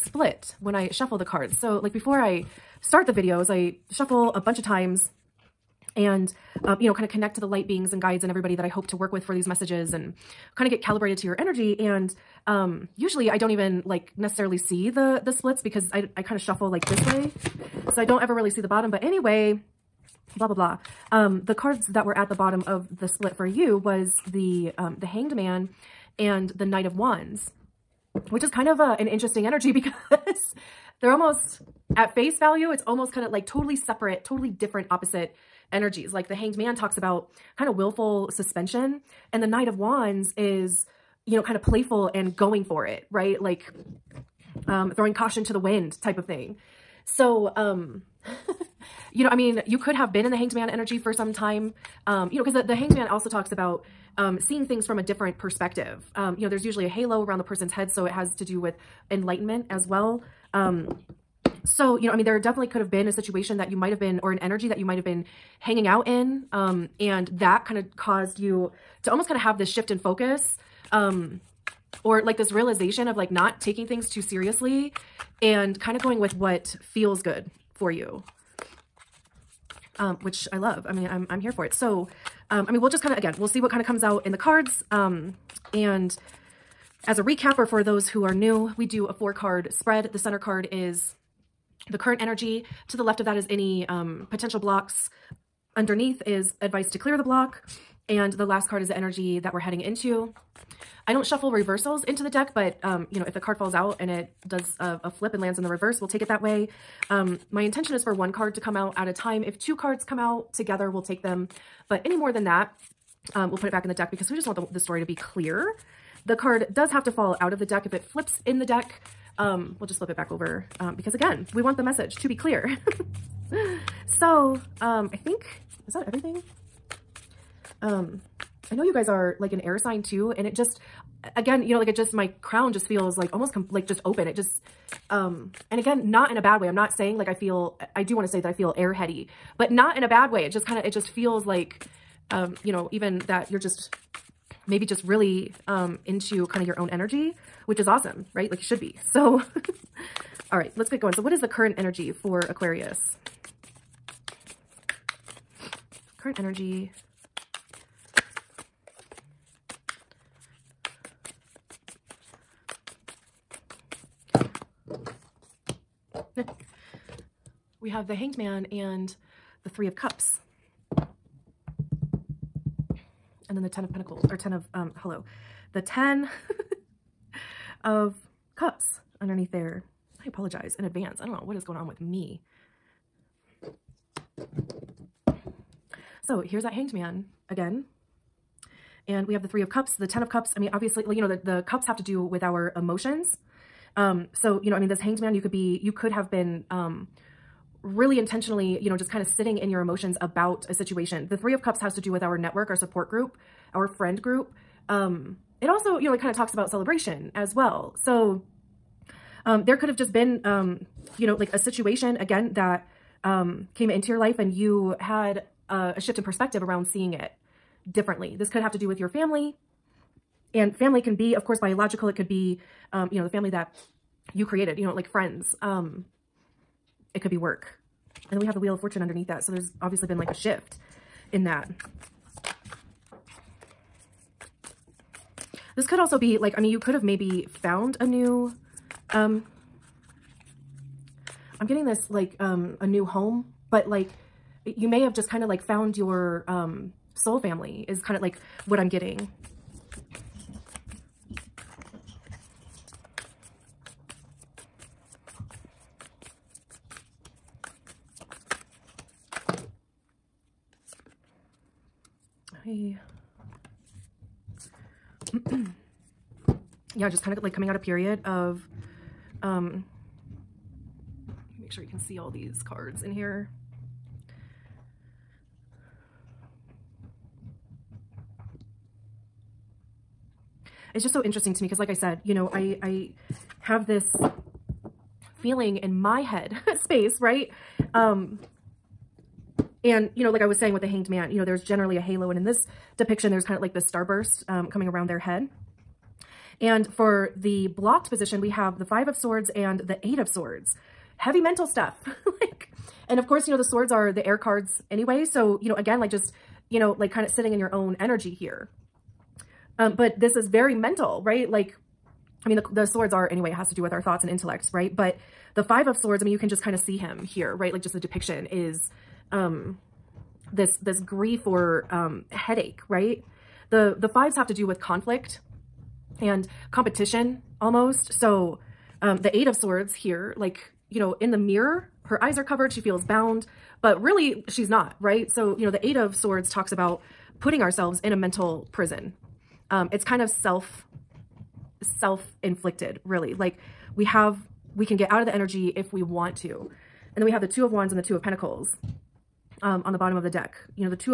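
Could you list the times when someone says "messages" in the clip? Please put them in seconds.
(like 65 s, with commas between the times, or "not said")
9 s, 121 s.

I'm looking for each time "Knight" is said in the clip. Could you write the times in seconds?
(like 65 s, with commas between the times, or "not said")
26 s, 39 s.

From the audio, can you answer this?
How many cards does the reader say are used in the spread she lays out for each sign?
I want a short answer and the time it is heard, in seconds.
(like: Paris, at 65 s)
4, at 89 s.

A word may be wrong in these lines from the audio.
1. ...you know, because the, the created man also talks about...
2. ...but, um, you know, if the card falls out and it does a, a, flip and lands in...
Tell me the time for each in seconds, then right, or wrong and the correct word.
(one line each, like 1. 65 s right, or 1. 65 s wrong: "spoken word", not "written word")
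1. 52 s wrong: "hanged", not "created"
2. 102 s right.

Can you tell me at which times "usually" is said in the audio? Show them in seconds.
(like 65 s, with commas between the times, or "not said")
12 s, 56 s.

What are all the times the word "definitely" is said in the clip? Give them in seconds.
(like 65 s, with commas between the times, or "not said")
62 s.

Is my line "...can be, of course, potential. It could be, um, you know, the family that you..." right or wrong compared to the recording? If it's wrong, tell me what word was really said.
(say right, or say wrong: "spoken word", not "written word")
wrong: "biological", not "potential".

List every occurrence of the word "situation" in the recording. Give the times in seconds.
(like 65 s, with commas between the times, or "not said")
63 s, 200 s, 211 s.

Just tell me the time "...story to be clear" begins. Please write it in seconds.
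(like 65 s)
114 s.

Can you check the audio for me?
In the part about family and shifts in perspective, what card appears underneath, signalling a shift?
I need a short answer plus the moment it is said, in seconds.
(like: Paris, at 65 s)
Wheel of Fortune, at 228 s.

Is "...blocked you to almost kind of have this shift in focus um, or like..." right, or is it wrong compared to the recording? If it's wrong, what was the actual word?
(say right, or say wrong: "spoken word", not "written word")
wrong: "caused", not "blocked".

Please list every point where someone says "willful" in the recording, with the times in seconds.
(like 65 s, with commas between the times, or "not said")
37 s.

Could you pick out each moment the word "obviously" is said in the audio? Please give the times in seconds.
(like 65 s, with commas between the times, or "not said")
190 s, 229 s.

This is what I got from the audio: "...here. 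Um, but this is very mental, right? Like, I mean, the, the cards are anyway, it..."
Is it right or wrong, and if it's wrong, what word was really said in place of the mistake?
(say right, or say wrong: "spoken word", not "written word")
wrong: "swords", not "cards".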